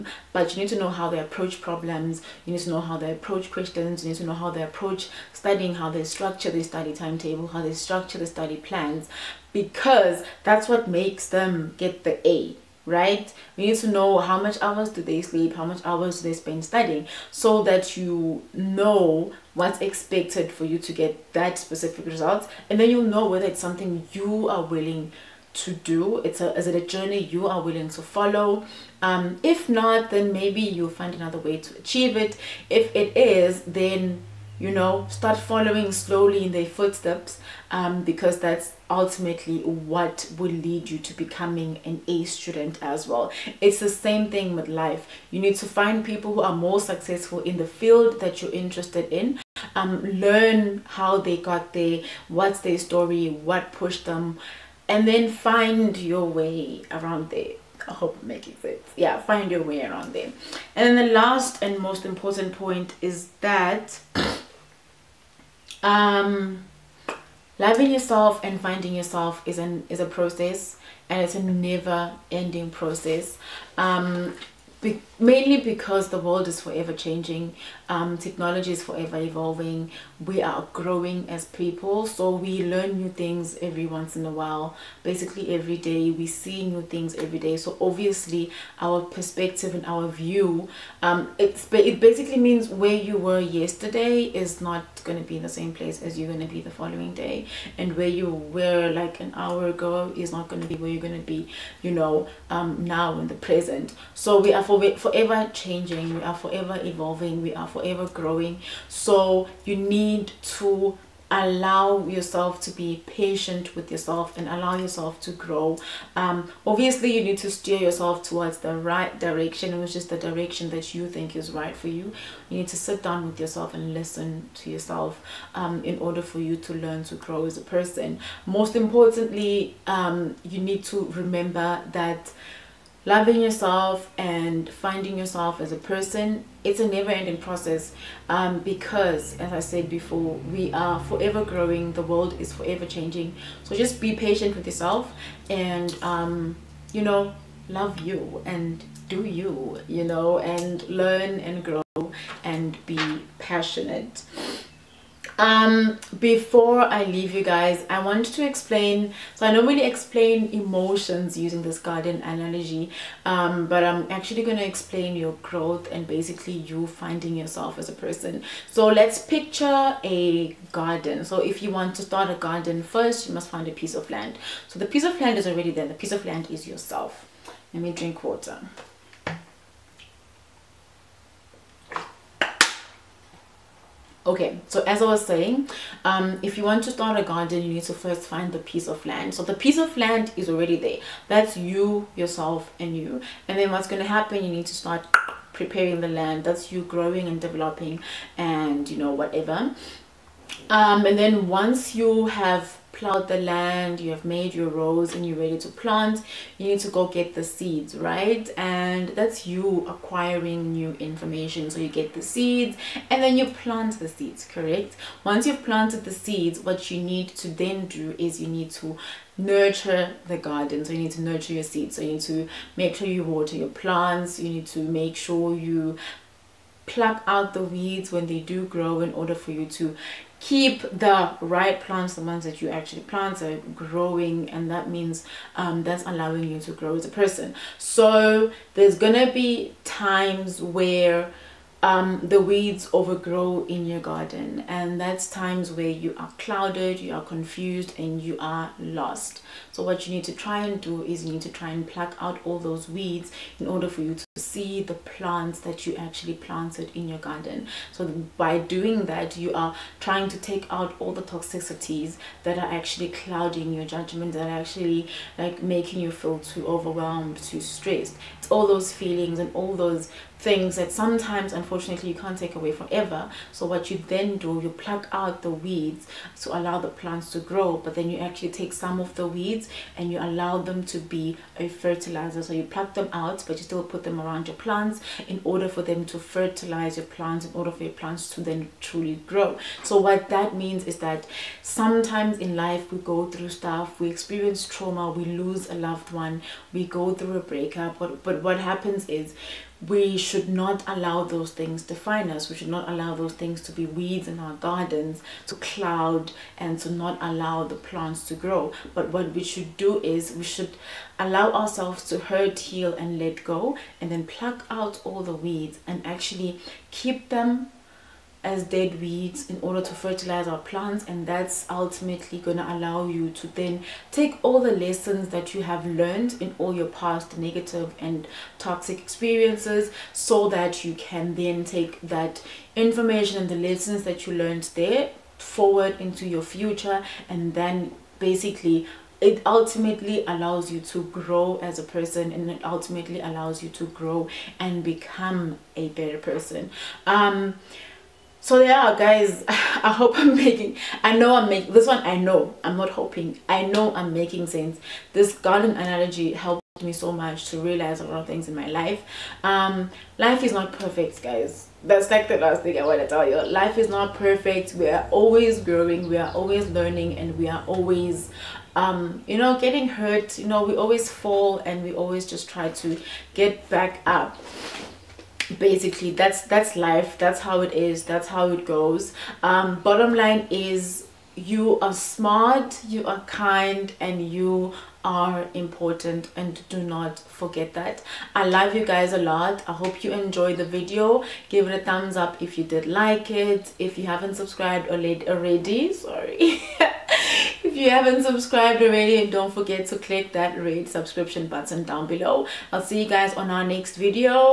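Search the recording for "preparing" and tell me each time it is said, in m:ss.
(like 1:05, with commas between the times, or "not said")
3:15.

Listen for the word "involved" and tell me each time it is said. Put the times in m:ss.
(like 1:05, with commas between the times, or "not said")
not said.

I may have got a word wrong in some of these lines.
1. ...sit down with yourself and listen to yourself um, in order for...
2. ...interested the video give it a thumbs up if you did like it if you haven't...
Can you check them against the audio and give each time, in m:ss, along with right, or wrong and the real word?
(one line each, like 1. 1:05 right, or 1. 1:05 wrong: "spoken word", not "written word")
1. 2:02 right
2. 6:30 wrong: "enjoyed", not "interested".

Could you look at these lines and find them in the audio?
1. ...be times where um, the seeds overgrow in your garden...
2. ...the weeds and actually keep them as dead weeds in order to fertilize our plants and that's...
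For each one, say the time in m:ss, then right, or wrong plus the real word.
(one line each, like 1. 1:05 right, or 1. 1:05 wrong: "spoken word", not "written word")
1. 3:59 wrong: "weeds", not "seeds"
2. 5:15 right.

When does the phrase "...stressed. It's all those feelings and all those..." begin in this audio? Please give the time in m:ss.
4:27.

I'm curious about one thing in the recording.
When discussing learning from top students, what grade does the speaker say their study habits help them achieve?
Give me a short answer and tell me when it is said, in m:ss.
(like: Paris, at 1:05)
an A, at 0:12.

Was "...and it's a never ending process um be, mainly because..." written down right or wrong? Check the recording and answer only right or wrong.
right.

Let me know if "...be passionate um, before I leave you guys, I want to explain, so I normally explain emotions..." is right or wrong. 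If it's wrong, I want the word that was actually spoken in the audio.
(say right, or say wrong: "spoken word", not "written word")
right.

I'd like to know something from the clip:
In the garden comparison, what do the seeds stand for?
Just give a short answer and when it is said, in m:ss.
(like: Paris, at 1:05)
acquiring new information, at 3:29.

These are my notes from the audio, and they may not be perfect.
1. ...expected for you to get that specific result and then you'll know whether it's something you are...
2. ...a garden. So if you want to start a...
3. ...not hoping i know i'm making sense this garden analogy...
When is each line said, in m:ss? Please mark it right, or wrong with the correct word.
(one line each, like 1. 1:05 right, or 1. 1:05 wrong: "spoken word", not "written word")
1. 0:19 right
2. 2:50 right
3. 5:52 right.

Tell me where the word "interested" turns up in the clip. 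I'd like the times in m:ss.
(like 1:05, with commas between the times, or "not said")
0:48.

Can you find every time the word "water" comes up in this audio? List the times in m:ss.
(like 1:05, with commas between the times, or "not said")
2:58, 3:43.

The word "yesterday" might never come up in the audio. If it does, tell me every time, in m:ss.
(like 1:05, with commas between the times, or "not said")
1:33.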